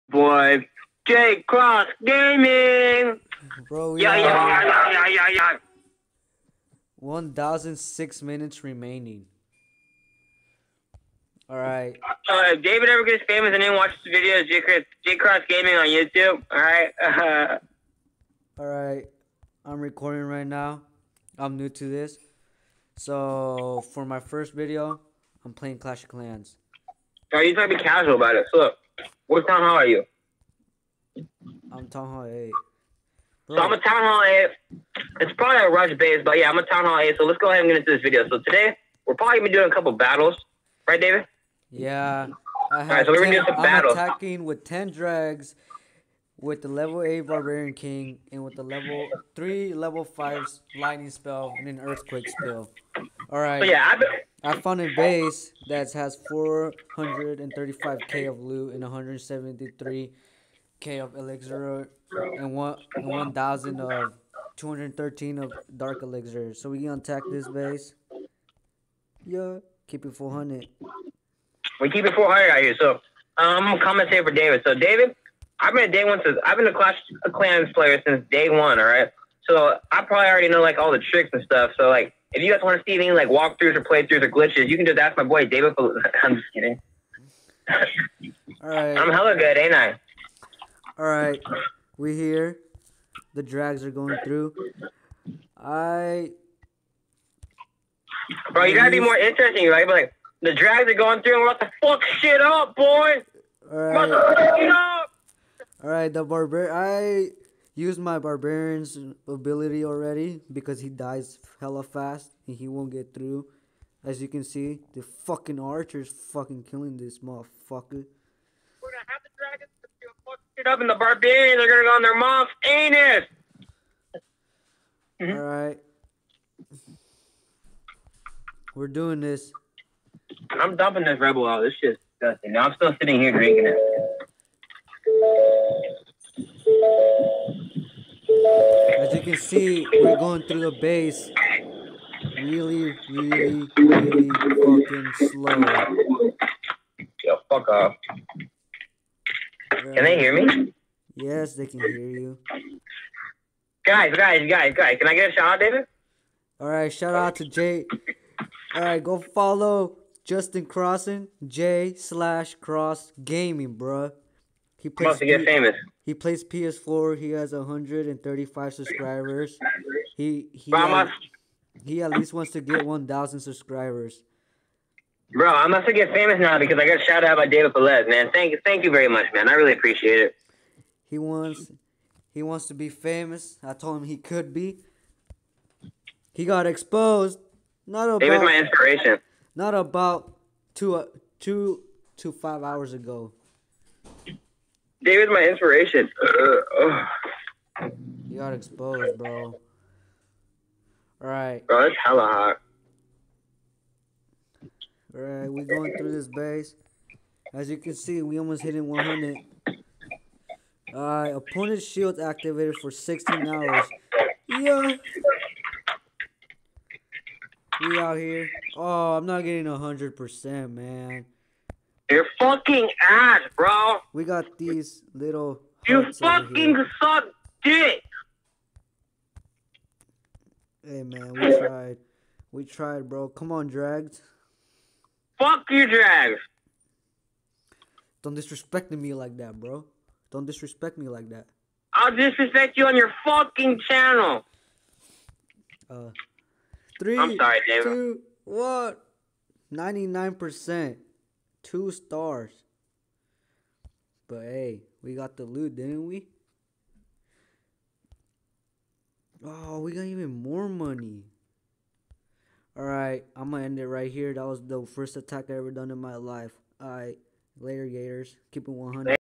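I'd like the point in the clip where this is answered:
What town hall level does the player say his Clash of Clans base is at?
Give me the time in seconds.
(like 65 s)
31 s.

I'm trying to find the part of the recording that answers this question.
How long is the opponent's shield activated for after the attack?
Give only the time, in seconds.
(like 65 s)
212 s.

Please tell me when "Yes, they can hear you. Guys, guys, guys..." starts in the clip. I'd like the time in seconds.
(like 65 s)
151 s.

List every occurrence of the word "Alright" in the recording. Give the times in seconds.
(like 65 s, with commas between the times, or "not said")
53 s, 205 s, 210 s, 262 s, 266 s.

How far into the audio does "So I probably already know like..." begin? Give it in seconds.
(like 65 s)
79 s.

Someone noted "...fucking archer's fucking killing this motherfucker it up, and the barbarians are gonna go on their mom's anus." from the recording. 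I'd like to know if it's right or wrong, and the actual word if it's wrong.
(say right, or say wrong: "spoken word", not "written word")
right.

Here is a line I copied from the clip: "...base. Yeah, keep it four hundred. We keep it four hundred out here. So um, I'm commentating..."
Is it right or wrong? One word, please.
right.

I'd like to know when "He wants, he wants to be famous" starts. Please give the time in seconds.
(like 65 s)
181 s.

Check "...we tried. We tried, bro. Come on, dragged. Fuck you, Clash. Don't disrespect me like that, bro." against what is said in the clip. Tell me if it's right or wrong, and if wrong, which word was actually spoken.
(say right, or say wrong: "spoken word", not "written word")
wrong: "Jags", not "Clash".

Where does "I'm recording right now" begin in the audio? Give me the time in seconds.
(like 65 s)
19 s.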